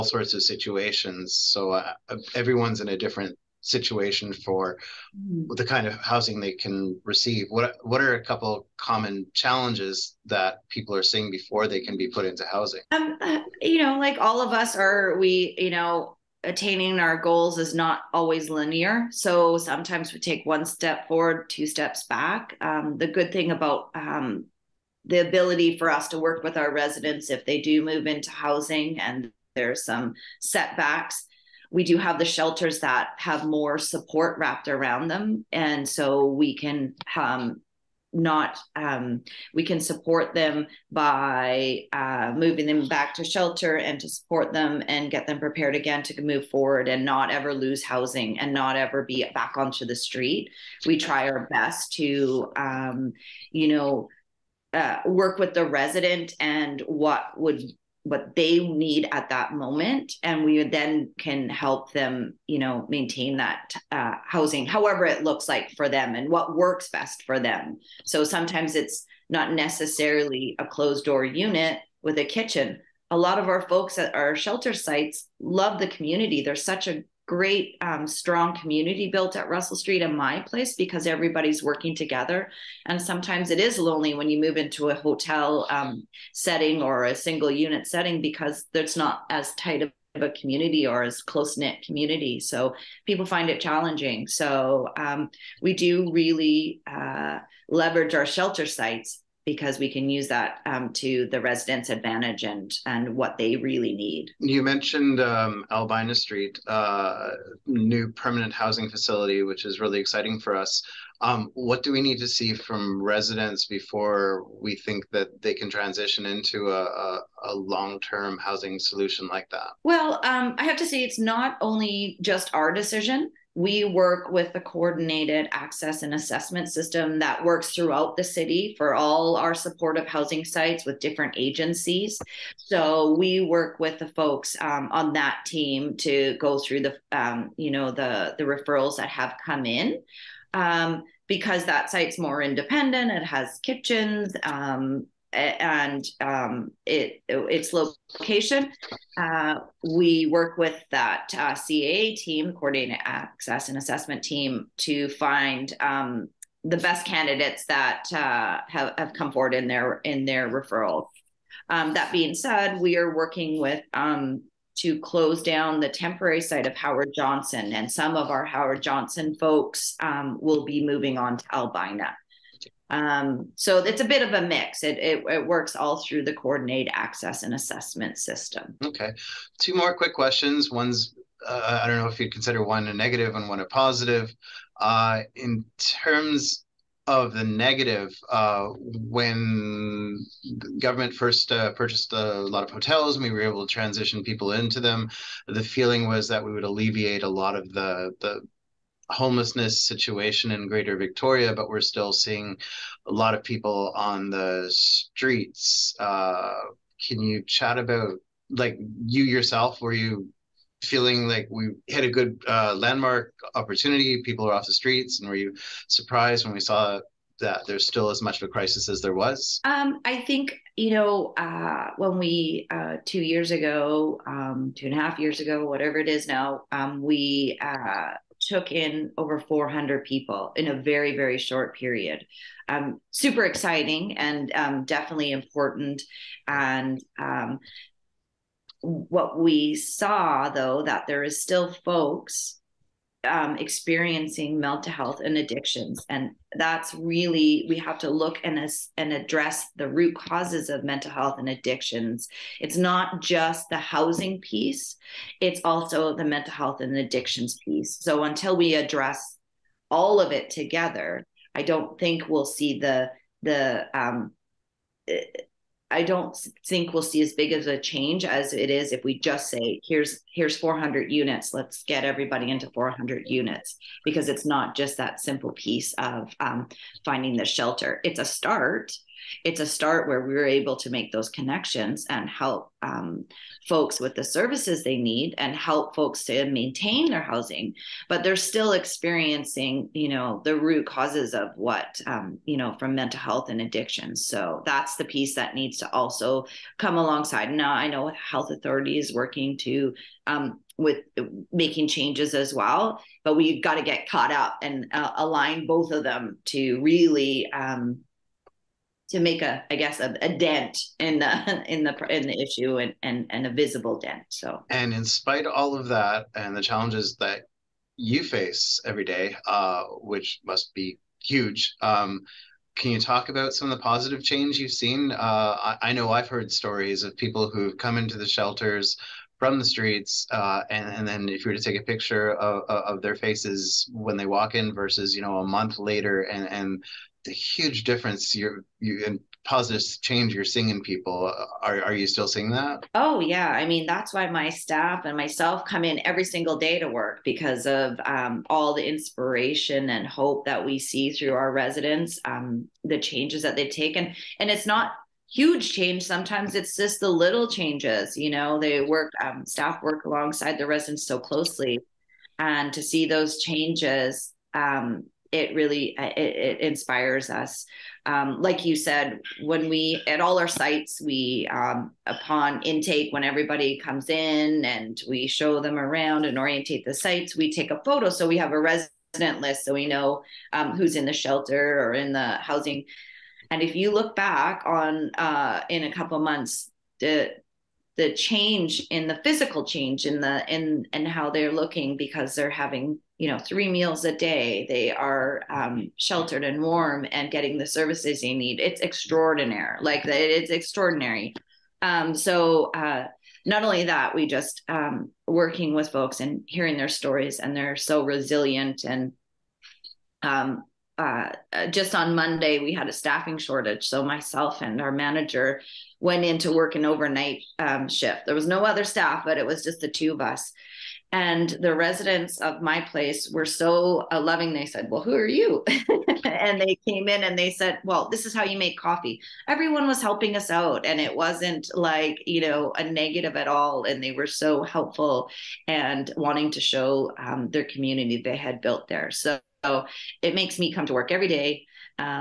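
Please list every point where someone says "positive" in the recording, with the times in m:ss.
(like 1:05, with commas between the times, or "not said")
3:03, 5:23, 5:39.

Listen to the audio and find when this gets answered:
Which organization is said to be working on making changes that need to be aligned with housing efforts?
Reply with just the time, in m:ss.
4:58.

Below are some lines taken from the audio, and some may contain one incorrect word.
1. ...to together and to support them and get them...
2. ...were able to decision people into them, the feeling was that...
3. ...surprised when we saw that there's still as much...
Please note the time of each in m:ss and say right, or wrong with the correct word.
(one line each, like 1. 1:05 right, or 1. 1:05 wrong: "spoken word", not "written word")
1. 0:43 wrong: "shelter", not "together"
2. 3:13 wrong: "transition", not "decision"
3. 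3:35 right.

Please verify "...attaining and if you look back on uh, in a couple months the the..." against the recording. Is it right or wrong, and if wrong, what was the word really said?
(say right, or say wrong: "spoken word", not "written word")
wrong: "housing", not "attaining".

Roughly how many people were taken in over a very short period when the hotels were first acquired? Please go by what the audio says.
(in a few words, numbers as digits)
over 400.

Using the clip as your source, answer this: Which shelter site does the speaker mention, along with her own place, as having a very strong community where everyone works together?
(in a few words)
Russell Street.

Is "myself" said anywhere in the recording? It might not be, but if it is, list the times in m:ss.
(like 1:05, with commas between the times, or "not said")
5:45, 6:54.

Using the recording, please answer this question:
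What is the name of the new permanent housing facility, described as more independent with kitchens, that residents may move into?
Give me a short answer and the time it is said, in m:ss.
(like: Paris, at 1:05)
Albina Street, at 1:45.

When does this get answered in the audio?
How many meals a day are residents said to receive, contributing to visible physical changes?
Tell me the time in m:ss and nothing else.
6:33.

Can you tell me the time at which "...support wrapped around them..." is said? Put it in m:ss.
0:33.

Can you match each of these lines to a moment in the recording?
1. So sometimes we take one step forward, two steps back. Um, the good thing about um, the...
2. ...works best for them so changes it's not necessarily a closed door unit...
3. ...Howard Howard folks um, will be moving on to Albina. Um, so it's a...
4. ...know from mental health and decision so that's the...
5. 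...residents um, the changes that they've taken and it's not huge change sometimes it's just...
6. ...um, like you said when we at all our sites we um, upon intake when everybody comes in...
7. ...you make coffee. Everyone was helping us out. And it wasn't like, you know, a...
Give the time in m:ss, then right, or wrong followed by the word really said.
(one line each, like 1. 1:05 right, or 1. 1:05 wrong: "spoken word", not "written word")
1. 0:19 right
2. 1:06 wrong: "sometimes", not "changes"
3. 2:48 wrong: "Johnson", not "Howard"
4. 4:52 wrong: "addiction", not "decision"
5. 5:51 right
6. 6:08 right
7. 7:08 right.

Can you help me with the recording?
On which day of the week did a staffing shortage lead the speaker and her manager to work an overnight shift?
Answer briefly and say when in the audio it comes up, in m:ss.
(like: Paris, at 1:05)
Monday, at 6:52.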